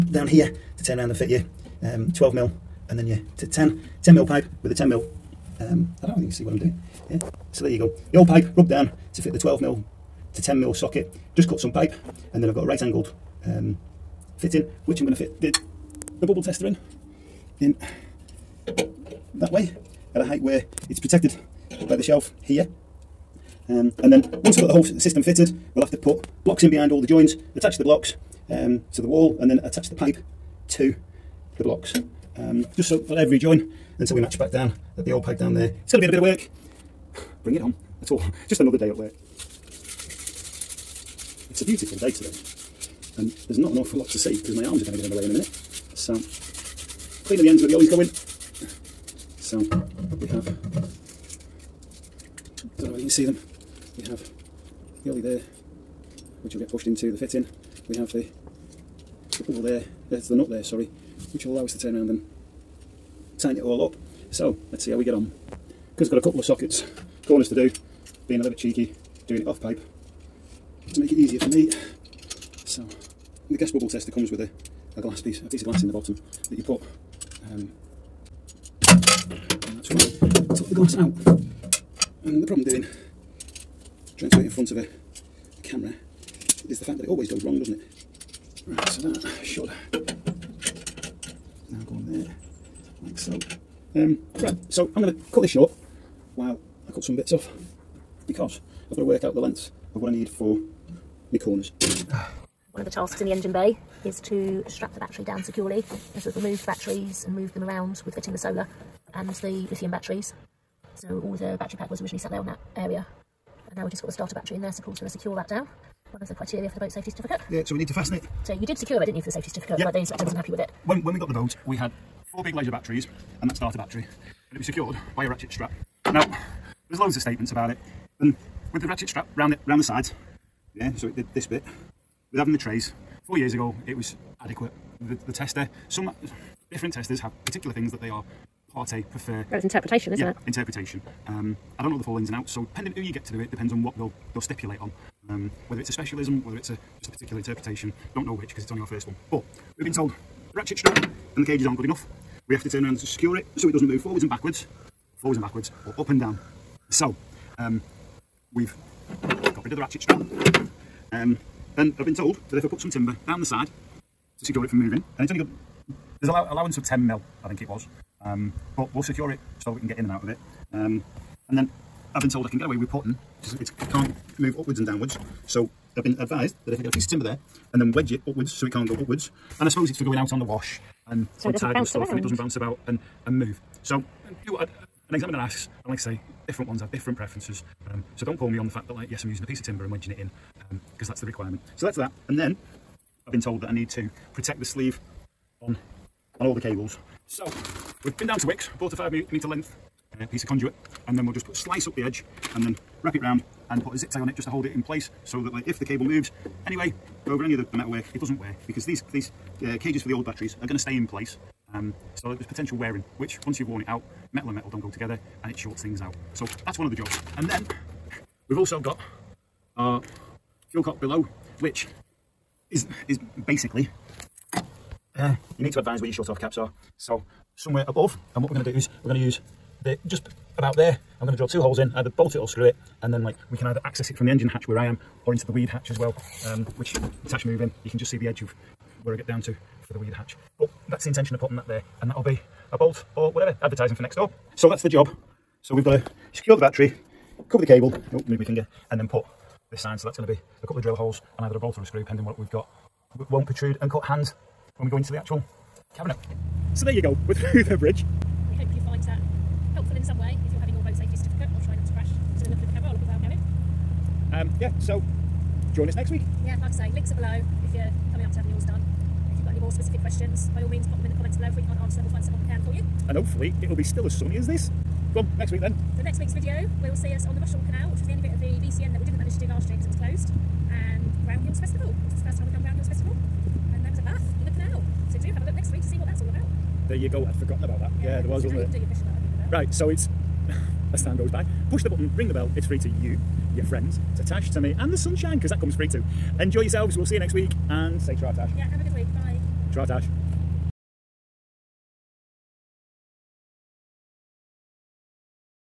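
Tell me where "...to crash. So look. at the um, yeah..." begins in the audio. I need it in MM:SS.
04:21.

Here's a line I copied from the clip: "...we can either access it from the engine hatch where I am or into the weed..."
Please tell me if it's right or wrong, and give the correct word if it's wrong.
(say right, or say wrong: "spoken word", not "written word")
right.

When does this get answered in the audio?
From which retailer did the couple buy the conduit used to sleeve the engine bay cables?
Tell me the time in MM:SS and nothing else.
03:18.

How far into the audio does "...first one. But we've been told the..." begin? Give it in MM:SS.
02:28.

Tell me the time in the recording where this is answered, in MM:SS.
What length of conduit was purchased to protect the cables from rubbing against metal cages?
03:18.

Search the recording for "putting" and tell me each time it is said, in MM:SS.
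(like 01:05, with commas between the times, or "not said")
02:52, 04:01.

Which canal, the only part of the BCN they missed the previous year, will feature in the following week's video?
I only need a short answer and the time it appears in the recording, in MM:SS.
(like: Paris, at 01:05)
Rushall Canal, at 04:37.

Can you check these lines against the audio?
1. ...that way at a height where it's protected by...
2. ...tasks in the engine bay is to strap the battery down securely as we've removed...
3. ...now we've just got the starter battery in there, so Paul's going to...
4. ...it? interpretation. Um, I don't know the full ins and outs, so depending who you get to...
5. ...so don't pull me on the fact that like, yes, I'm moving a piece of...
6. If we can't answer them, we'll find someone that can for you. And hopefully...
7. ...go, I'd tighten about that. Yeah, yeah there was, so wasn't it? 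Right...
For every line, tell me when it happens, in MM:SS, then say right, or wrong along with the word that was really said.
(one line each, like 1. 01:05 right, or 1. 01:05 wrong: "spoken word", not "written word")
1. 00:19 right
2. 01:42 right
3. 01:53 right
4. 02:20 right
5. 03:08 wrong: "using", not "moving"
6. 04:31 right
7. 04:47 wrong: "forgotten", not "tighten".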